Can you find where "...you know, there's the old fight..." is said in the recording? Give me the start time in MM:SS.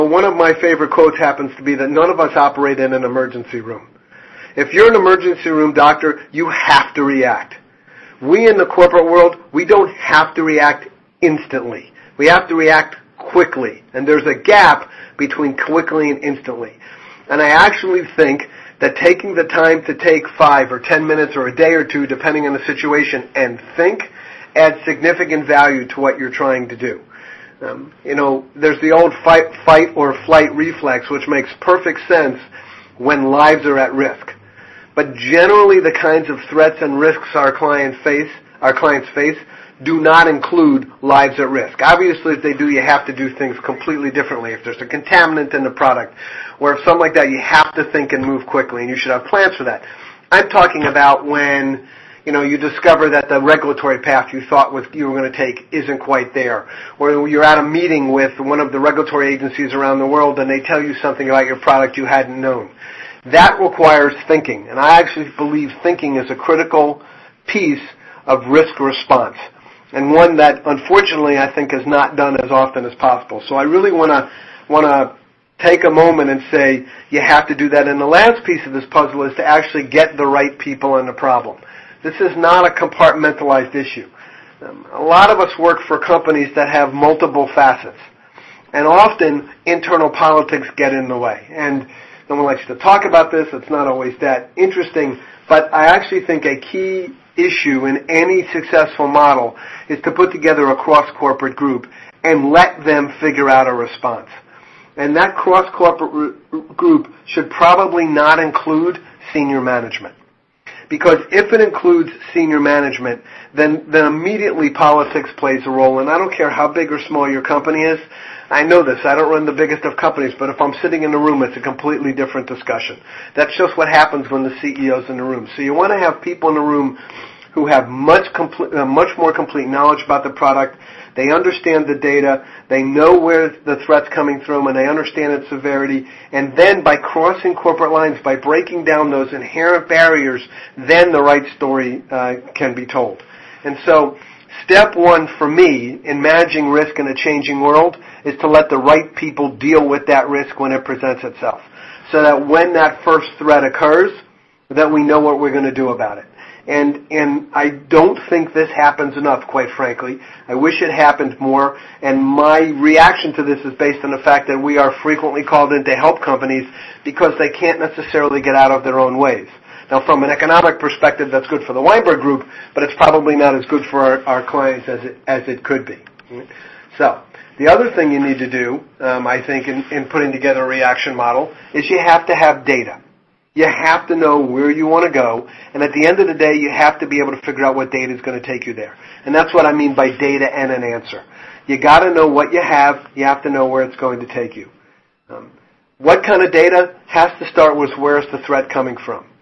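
00:28.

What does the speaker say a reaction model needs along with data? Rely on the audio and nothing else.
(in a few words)
An answer.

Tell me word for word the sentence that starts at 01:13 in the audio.
So I really want to want to take a moment and say you have to do that.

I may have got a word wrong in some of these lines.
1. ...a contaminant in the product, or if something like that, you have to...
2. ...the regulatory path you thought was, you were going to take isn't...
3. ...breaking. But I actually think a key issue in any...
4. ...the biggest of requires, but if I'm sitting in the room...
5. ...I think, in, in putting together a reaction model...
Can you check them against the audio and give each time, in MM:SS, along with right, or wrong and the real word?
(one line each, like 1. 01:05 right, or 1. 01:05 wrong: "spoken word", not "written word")
1. 00:44 right
2. 00:53 right
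3. 01:34 wrong: "interesting", not "breaking"
4. 01:59 wrong: "companies", not "requires"
5. 02:59 right.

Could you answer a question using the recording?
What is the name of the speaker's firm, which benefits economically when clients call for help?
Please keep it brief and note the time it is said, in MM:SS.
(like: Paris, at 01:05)
Weinberg Group, at 02:51.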